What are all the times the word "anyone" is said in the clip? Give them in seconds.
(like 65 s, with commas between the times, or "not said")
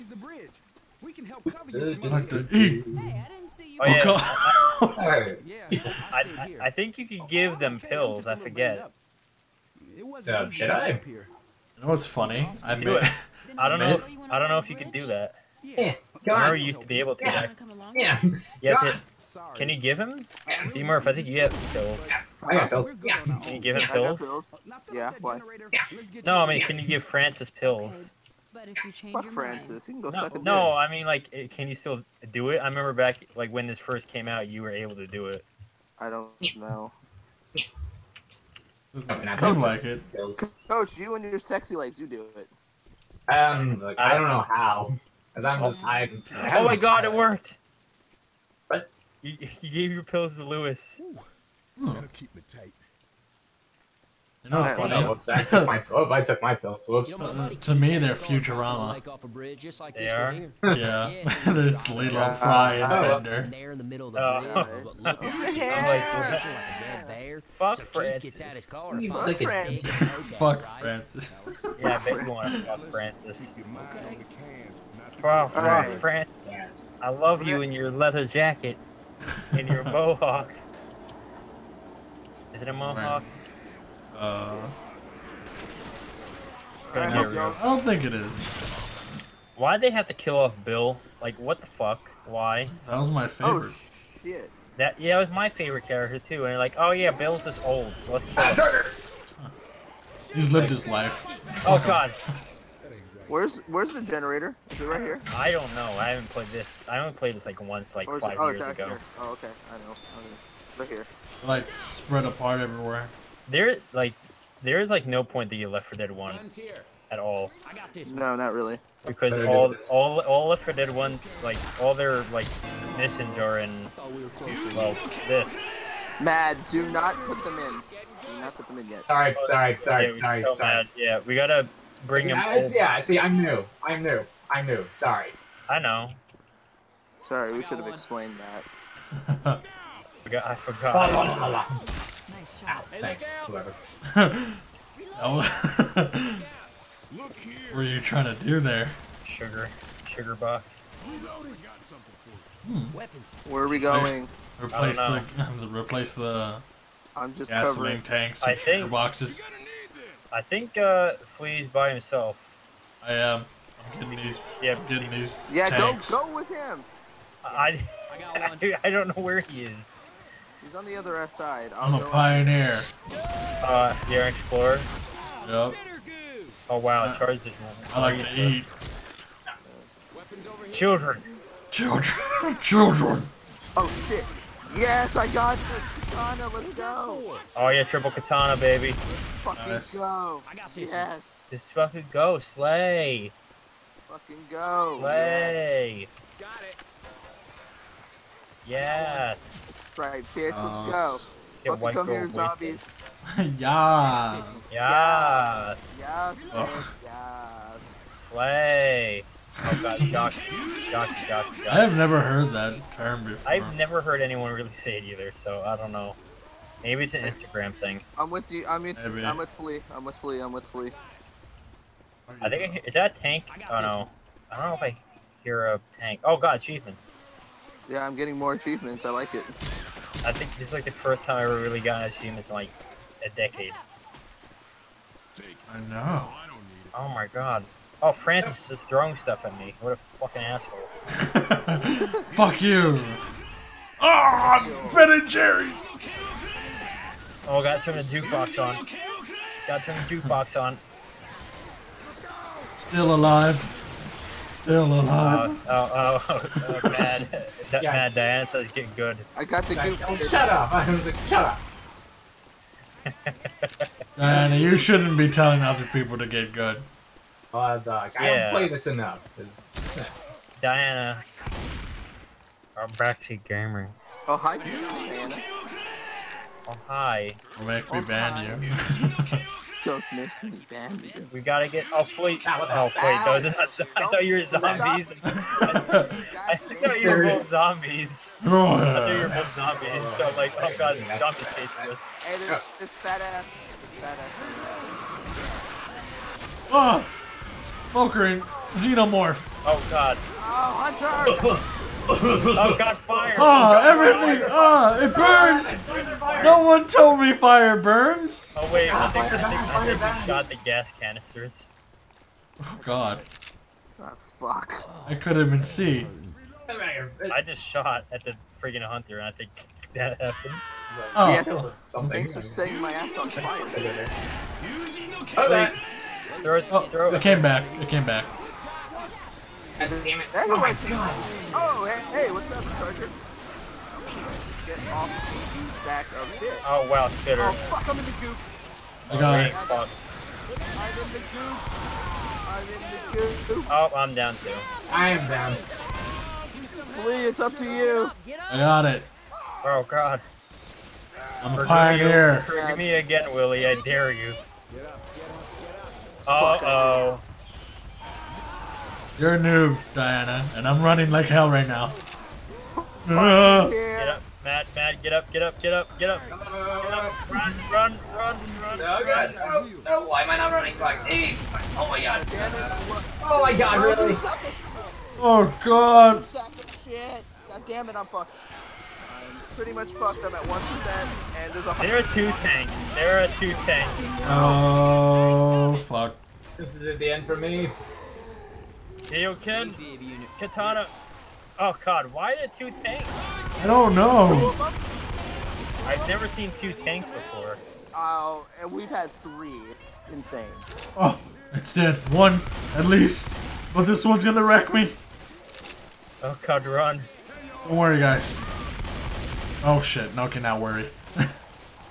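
214 s.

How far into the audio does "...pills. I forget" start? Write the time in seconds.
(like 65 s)
7 s.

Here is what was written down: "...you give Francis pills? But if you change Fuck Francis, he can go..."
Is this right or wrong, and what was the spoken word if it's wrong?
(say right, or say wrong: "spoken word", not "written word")
right.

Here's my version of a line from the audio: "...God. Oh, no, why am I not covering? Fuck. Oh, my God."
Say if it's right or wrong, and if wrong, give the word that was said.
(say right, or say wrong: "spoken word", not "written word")
wrong: "running", not "covering".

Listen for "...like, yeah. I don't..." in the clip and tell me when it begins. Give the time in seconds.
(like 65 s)
267 s.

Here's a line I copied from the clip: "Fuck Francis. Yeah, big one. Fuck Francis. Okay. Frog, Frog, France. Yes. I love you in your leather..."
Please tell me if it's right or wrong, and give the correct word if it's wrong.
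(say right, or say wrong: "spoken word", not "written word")
right.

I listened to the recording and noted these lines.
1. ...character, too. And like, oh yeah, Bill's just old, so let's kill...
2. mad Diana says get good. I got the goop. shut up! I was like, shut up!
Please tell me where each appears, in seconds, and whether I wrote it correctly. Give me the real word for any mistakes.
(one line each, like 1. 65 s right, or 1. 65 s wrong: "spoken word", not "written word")
1. 95 s right
2. 257 s right.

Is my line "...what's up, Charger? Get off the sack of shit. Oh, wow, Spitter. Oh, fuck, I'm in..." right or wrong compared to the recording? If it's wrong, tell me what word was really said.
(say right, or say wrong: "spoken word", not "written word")
right.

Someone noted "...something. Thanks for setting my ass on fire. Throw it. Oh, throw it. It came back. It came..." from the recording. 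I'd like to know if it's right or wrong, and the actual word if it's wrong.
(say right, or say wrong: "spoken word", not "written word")
right.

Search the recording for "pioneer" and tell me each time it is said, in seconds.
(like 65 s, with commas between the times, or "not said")
172 s, 351 s.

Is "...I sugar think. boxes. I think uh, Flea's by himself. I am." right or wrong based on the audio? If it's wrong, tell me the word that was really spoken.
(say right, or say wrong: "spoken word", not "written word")
right.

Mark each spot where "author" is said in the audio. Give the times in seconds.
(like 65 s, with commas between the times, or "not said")
not said.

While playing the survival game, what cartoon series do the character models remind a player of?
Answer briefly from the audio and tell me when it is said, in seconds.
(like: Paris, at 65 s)
Futurama, at 58 s.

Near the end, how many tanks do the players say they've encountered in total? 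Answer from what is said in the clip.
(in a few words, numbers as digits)
3.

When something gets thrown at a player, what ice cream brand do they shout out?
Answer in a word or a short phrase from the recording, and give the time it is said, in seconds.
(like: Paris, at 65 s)
Ben and Jerry's, at 244 s.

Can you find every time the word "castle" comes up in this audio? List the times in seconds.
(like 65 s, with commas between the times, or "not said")
not said.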